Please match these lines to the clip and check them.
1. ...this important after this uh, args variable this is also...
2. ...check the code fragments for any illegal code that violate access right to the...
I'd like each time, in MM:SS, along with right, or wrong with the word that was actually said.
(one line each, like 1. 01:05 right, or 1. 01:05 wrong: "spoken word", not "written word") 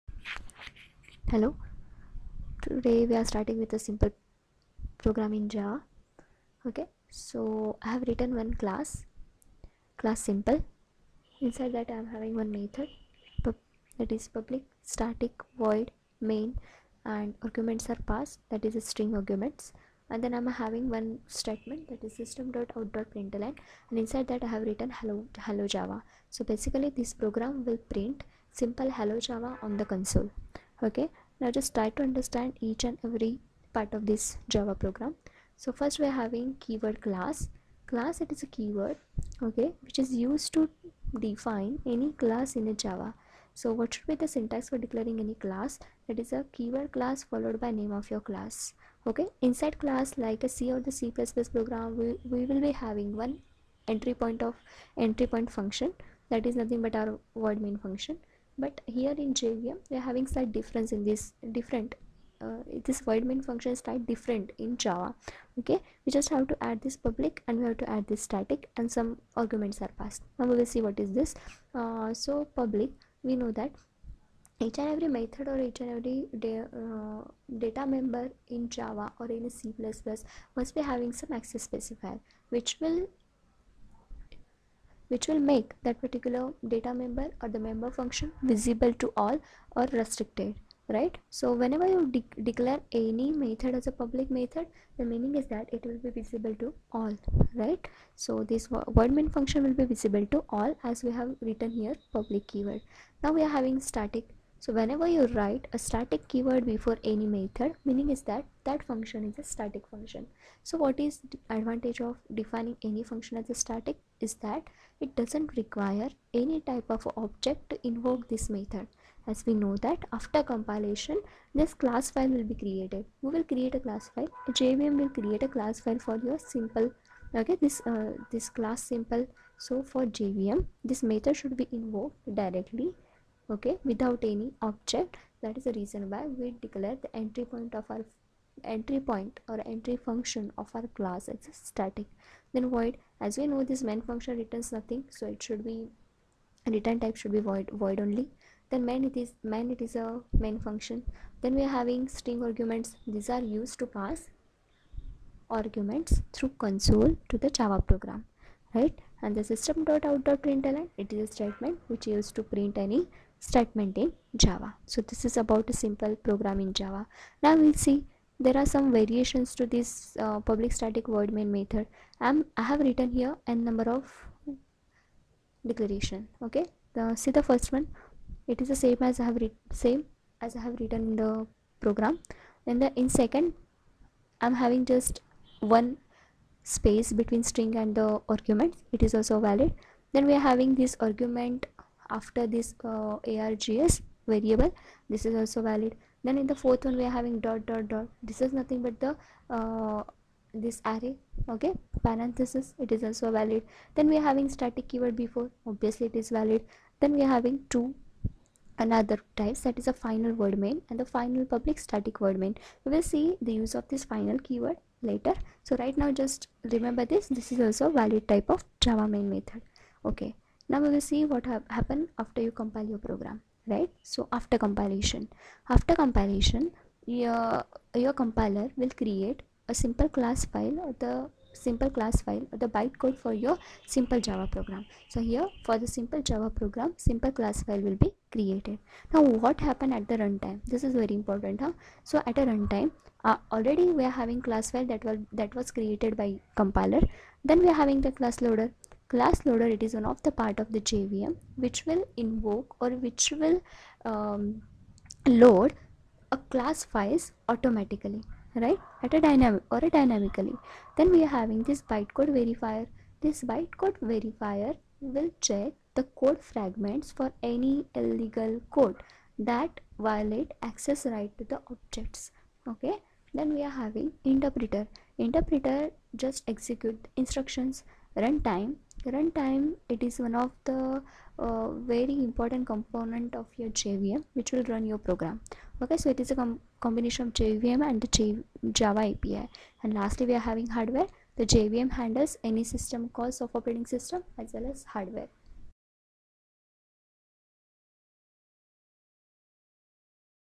1. 03:10 wrong: "argument", not "important"
2. 04:25 right.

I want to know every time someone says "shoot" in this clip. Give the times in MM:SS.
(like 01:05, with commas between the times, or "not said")
not said.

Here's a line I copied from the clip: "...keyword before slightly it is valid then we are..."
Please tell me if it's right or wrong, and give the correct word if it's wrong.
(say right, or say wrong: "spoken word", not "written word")
wrong: "obviously", not "slightly".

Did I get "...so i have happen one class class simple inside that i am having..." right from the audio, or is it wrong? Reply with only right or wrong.
wrong.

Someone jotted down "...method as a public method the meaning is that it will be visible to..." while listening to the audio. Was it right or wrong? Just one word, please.
right.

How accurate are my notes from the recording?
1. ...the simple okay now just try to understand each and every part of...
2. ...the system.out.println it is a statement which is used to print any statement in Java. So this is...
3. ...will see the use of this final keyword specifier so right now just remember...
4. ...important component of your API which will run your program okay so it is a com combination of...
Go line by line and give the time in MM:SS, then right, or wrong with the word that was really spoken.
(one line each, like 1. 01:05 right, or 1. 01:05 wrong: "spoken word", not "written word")
1. 00:29 wrong: "console", not "simple"
2. 02:39 right
3. 03:32 wrong: "later", not "specifier"
4. 04:42 wrong: "JVM", not "API".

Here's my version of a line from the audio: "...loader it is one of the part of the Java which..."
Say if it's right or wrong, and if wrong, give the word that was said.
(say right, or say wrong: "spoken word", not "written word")
wrong: "JVM", not "Java".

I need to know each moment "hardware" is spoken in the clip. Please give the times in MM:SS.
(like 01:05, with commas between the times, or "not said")
04:50, 04:54.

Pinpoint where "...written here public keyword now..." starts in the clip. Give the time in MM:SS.
01:41.